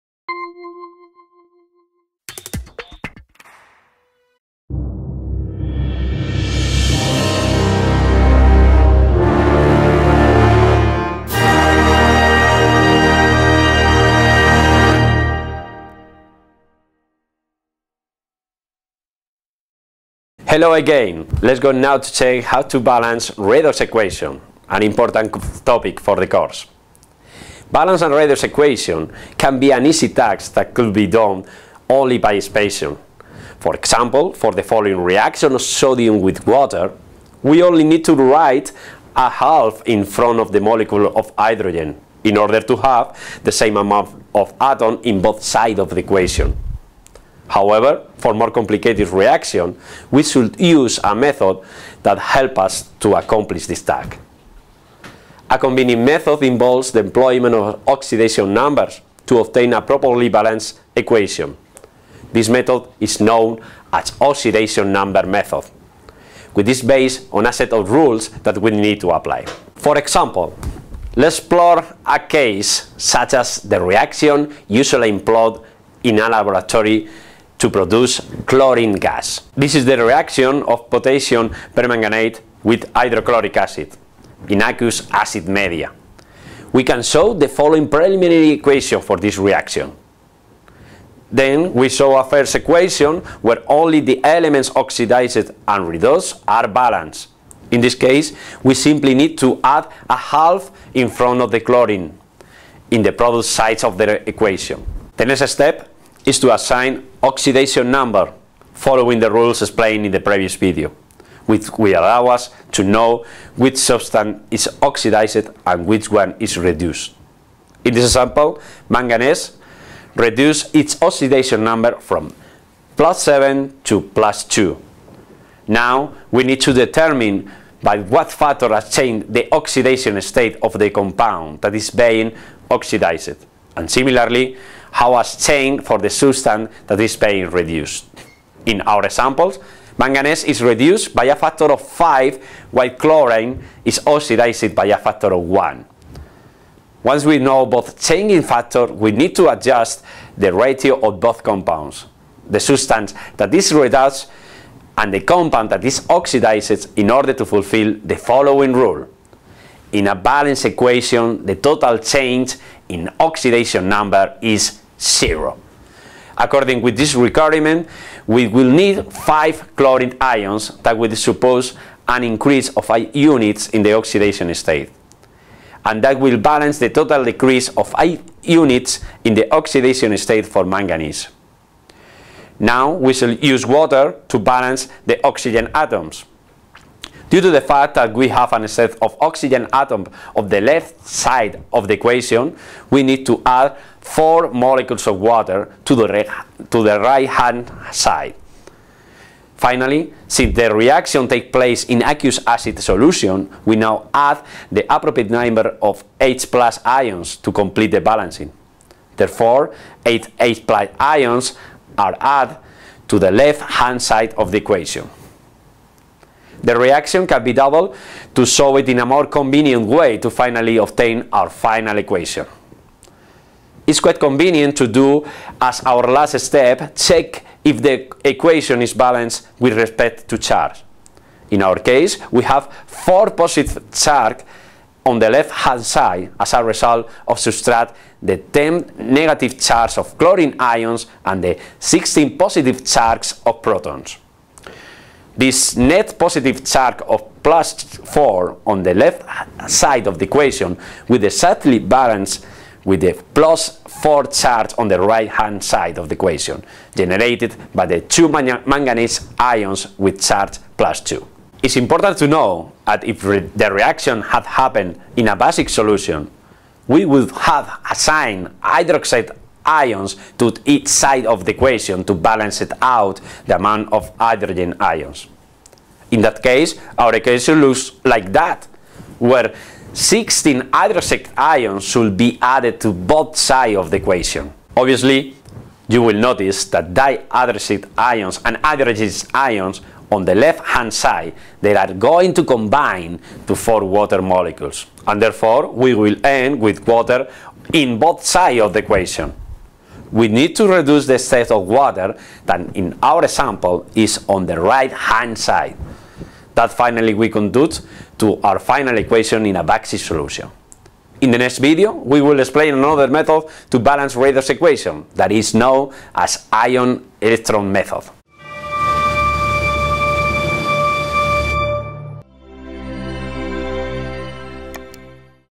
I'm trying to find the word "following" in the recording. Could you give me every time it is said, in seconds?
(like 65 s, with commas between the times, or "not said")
34 s, 87 s, 108 s, 158 s.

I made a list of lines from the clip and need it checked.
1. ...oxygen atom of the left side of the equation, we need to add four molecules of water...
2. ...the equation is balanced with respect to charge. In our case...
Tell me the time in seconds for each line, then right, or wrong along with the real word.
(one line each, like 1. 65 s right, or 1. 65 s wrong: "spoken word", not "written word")
1. 189 s right
2. 227 s right.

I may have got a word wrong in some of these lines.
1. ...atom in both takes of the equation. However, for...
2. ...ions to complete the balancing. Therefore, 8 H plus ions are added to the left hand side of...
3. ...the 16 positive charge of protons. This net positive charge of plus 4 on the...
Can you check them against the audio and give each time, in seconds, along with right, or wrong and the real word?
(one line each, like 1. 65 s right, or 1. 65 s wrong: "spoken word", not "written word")
1. 44 s wrong: "sides", not "takes"
2. 206 s right
3. 241 s right.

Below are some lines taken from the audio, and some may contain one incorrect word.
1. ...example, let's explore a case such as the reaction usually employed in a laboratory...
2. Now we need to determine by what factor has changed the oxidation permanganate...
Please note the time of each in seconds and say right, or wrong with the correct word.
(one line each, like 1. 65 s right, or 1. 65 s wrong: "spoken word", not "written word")
1. 69 s right
2. 125 s wrong: "state", not "permanganate".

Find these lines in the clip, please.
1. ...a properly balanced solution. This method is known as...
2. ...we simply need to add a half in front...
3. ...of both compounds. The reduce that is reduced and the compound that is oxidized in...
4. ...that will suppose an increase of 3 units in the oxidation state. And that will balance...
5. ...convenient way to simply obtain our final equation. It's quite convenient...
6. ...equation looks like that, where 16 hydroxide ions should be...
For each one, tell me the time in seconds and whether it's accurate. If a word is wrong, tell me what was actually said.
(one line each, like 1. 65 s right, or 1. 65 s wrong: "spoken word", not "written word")
1. 59 s wrong: "equation", not "solution"
2. 98 s right
3. 150 s wrong: "substance", not "reduce"
4. 170 s wrong: "8", not "3"
5. 219 s wrong: "finally", not "simply"
6. 277 s right.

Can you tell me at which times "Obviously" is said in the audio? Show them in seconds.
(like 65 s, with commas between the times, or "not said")
284 s.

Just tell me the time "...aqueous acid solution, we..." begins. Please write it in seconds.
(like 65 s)
202 s.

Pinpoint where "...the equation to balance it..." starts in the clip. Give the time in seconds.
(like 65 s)
271 s.